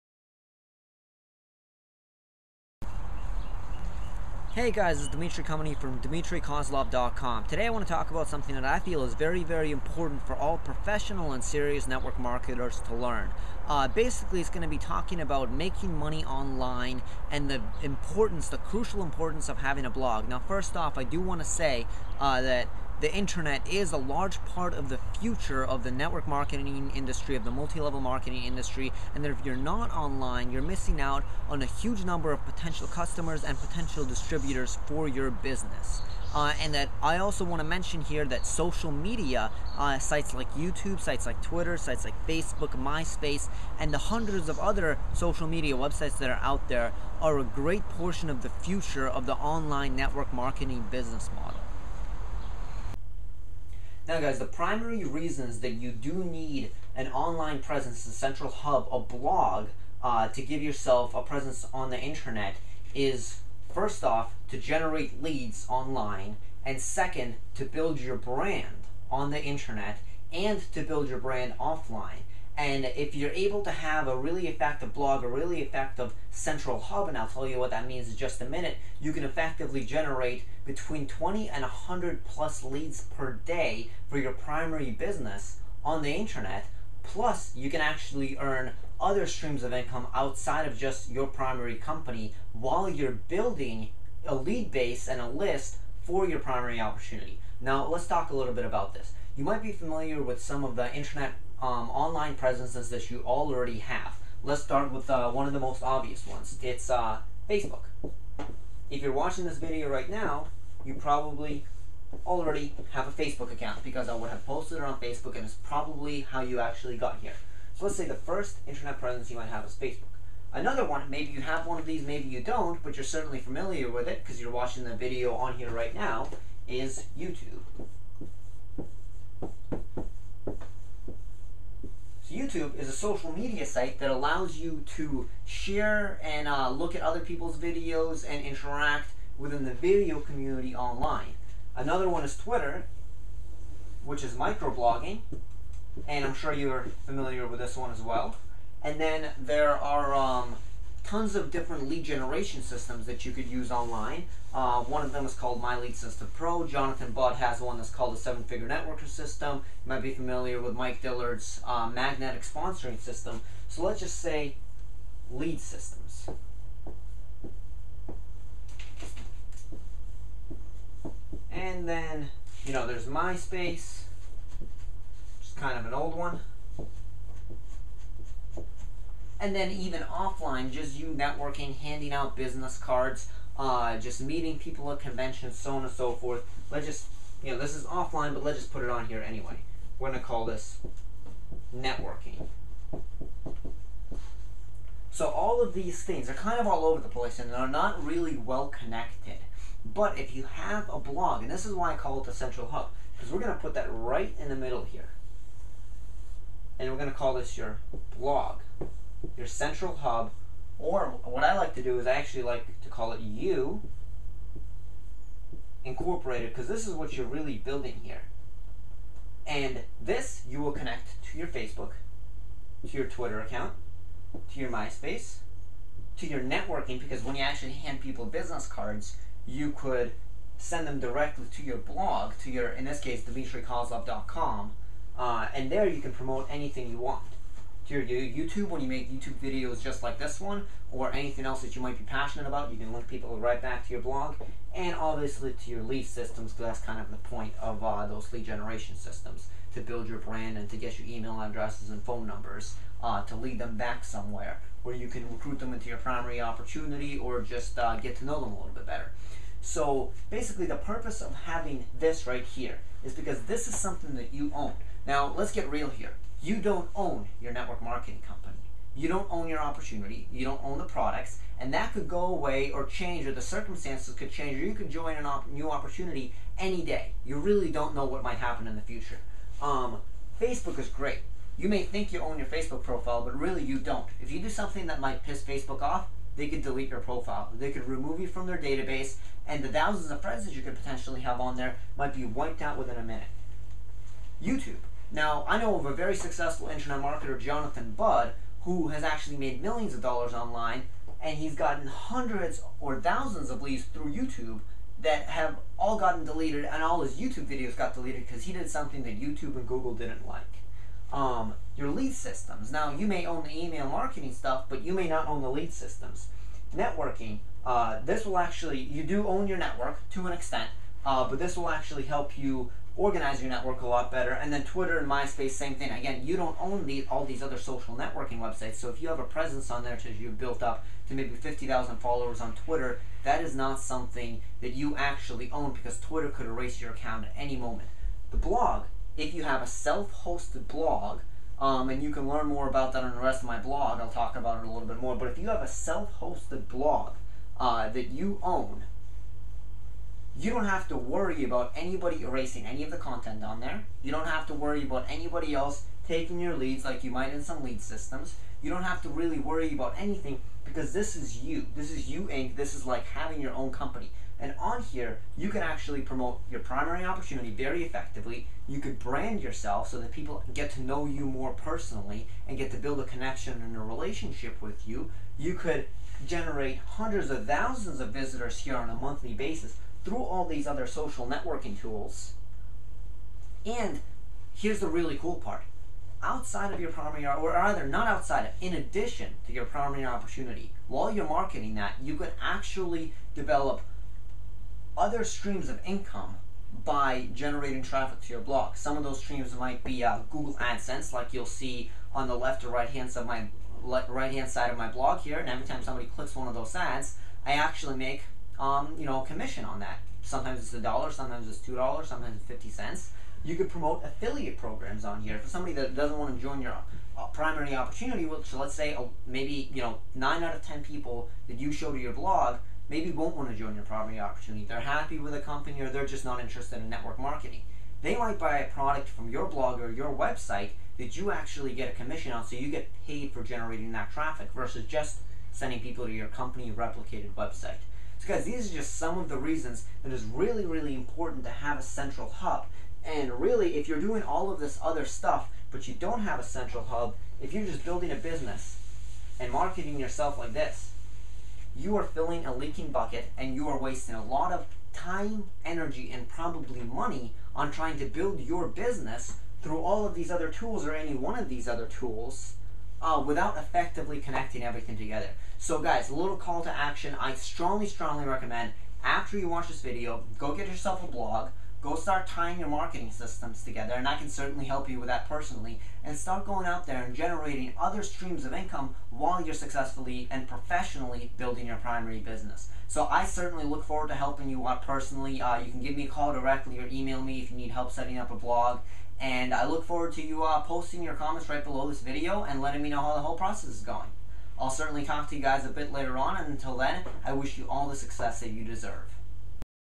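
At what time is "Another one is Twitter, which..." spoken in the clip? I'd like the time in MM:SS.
02:21.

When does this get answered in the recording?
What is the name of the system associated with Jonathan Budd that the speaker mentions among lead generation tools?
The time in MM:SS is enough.
02:38.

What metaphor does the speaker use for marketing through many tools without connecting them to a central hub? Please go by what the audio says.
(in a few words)
a leaking bucket.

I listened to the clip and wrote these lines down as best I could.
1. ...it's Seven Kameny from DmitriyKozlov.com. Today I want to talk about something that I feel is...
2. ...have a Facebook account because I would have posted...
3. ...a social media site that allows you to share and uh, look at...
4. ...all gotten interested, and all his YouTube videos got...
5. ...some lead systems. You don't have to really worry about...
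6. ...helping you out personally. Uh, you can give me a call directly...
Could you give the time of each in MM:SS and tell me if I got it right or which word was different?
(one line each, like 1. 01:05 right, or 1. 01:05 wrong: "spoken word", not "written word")
1. 00:04 wrong: "Dmitry", not "Seven"
2. 01:52 right
3. 02:12 right
4. 05:05 wrong: "deleted", not "interested"
5. 05:57 right
6. 08:04 right.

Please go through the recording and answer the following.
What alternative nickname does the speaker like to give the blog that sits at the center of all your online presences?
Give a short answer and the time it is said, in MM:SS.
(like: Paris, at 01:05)
You Incorporated, at 03:33.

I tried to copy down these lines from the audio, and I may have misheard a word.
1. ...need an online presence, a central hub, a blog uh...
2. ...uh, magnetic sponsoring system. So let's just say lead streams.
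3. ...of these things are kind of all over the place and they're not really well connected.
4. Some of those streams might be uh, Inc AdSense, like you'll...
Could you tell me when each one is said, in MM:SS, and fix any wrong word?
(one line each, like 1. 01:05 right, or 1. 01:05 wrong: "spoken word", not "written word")
1. 00:56 right
2. 02:41 wrong: "systems", not "streams"
3. 03:15 right
4. 06:38 wrong: "Google", not "Inc".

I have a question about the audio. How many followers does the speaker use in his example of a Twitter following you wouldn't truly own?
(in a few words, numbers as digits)
50,000.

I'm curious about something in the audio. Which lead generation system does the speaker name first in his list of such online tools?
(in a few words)
My Lead System Pro.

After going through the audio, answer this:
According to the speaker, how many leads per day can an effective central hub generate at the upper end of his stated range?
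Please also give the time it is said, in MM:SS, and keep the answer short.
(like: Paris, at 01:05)
100 plus, at 01:21.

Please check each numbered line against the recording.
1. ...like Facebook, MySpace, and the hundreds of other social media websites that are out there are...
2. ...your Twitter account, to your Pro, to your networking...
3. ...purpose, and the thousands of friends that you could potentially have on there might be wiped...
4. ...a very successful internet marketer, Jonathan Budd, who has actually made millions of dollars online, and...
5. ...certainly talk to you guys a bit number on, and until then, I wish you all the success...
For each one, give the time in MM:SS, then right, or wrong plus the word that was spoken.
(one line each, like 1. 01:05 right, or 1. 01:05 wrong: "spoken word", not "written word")
1. 00:42 right
2. 03:42 wrong: "MySpace", not "Pro"
3. 04:48 wrong: "database", not "purpose"
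4. 04:55 right
5. 08:14 wrong: "later", not "number".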